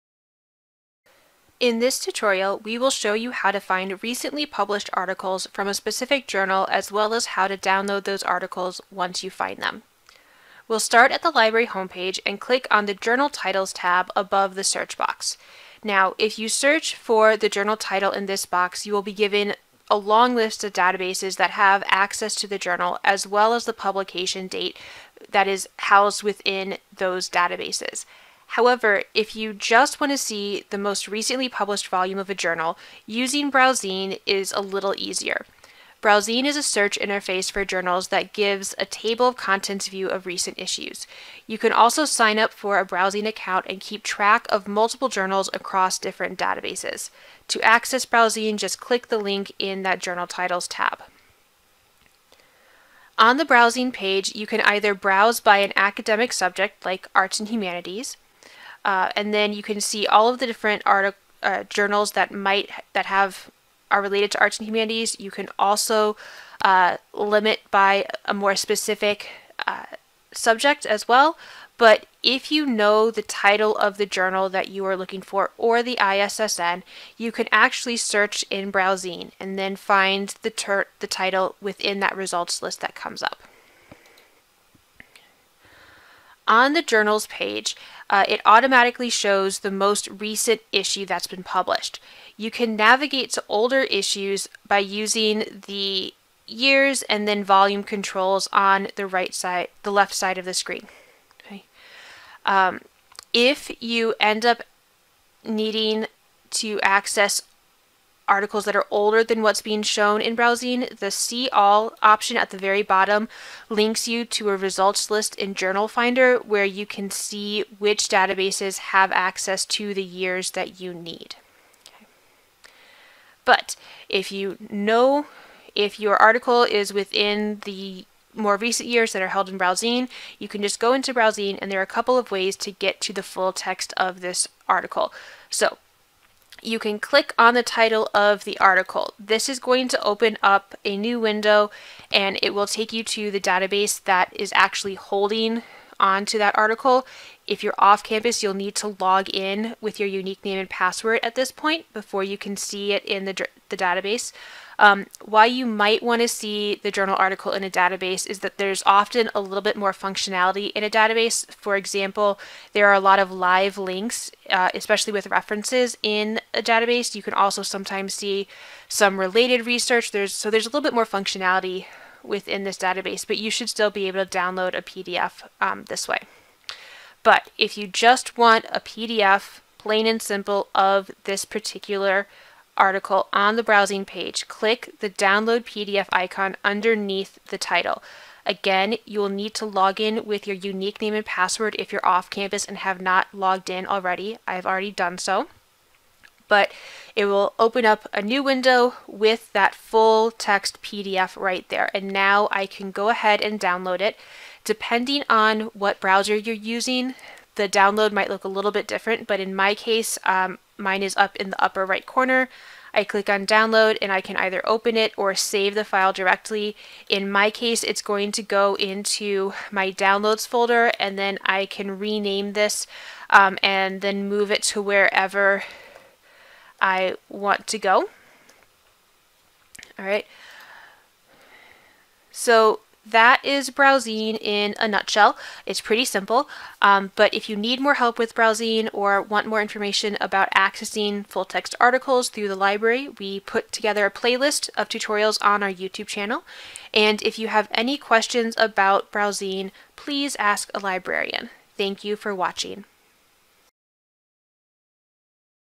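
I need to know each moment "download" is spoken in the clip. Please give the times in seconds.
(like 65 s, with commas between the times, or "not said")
7 s, 174 s, 185 s, 203 s, 207 s, 213 s, 219 s.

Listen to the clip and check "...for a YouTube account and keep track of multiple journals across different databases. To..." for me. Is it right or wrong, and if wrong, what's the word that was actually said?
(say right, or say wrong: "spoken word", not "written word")
wrong: "BrowZine", not "YouTube".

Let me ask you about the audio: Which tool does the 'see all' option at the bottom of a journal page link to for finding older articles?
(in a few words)
Journal Finder.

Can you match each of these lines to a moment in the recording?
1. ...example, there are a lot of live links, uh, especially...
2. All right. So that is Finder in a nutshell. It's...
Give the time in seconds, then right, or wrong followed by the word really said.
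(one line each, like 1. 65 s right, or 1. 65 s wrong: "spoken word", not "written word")
1. 161 s right
2. 229 s wrong: "BrowZine", not "Finder".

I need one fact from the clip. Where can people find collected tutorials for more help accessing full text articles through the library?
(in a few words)
YouTube channel.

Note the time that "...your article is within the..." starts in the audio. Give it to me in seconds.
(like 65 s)
125 s.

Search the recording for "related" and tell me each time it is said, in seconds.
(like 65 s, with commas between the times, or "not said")
64 s, 169 s.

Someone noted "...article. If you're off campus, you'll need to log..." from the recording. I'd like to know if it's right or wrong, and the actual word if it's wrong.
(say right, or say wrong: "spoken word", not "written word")
right.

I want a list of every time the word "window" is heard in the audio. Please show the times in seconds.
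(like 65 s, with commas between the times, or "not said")
141 s, 198 s.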